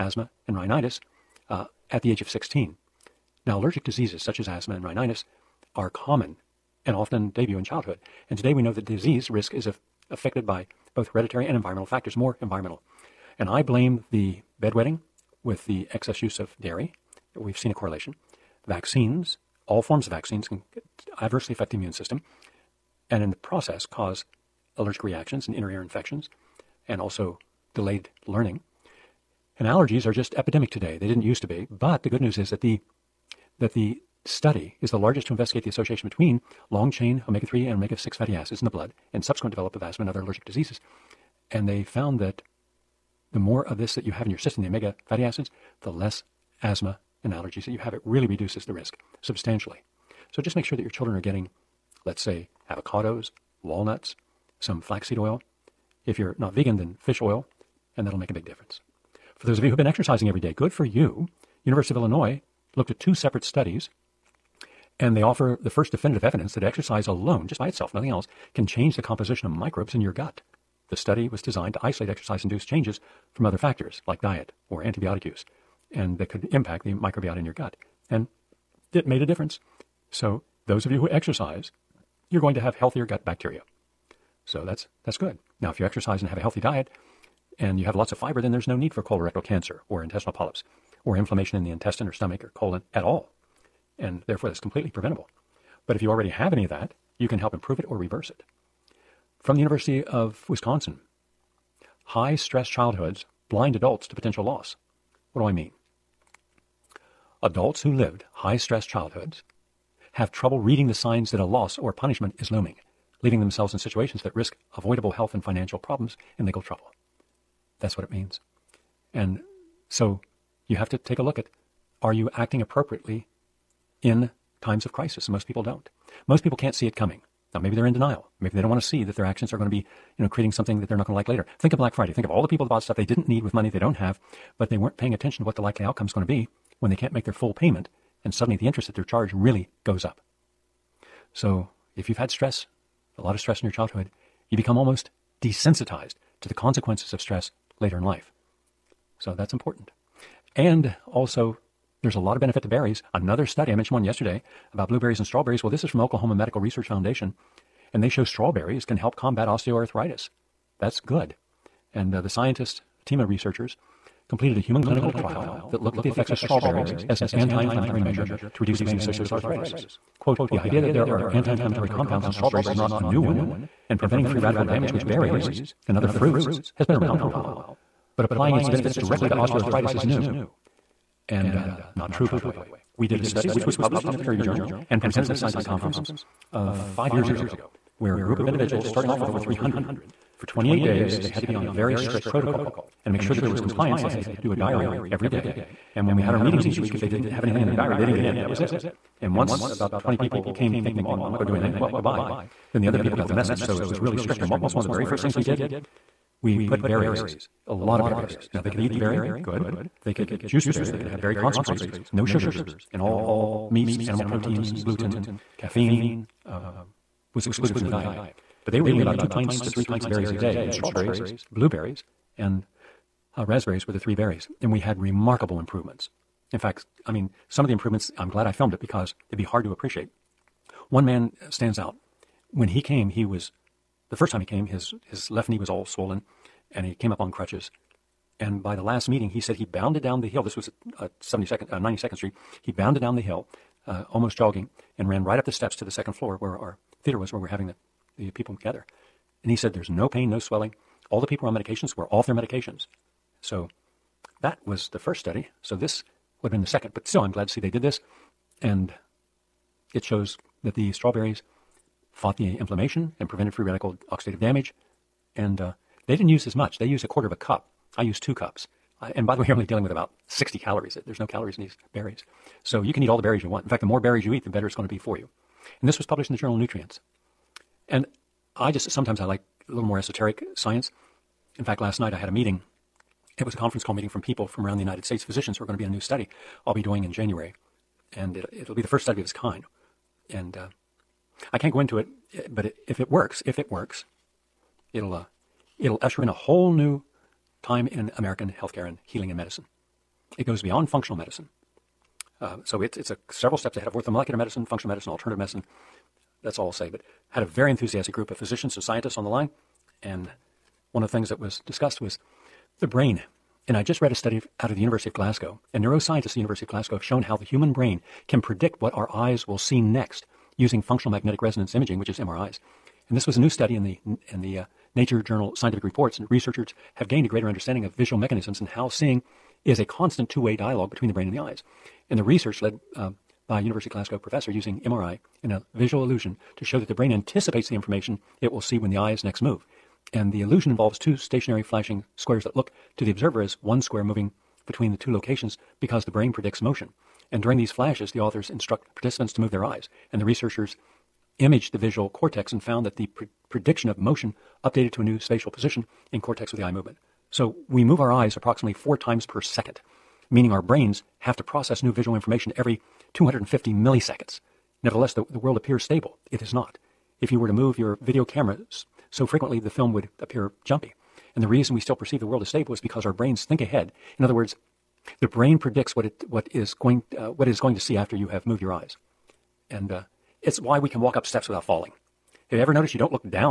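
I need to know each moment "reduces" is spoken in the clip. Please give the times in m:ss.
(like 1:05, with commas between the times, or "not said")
0:48, 2:48.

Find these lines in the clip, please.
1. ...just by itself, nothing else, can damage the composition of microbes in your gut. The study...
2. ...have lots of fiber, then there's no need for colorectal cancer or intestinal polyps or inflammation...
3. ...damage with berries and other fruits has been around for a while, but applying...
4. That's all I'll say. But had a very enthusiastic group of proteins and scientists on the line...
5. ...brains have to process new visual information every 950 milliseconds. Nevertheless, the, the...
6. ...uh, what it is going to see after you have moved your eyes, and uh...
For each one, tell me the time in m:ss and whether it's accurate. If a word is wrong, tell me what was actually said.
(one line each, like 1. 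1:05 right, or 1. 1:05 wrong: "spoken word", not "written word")
1. 1:07 wrong: "change", not "damage"
2. 1:27 right
3. 2:54 right
4. 5:06 wrong: "physicians", not "proteins"
5. 6:00 wrong: "250", not "950"
6. 6:17 right.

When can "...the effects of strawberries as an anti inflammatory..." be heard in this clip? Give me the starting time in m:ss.
2:46.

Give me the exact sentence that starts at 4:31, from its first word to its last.
There's no calories in these berries.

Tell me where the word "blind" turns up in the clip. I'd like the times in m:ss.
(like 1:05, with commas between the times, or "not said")
1:43.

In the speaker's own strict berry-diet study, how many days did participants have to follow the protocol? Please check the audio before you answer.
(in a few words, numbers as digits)
28.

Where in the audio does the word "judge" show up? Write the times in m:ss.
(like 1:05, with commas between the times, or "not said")
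not said.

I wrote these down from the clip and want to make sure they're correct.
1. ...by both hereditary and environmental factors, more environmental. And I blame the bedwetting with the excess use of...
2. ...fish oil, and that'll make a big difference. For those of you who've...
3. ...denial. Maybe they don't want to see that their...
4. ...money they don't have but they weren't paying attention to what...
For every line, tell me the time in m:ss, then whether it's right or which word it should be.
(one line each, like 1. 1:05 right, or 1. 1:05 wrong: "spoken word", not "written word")
1. 0:10 right
2. 0:56 right
3. 2:07 right
4. 2:13 right.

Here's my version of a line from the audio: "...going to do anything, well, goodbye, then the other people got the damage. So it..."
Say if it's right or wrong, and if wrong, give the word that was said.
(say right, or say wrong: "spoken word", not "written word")
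wrong: "message", not "damage".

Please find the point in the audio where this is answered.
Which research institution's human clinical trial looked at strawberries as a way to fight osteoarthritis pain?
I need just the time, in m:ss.
2:35.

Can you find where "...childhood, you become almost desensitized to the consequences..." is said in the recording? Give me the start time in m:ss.
2:23.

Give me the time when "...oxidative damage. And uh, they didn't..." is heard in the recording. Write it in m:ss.
4:24.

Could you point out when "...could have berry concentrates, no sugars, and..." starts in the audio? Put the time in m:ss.
3:30.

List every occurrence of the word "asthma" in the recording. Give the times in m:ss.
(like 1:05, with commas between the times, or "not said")
0:04, 0:39, 0:46.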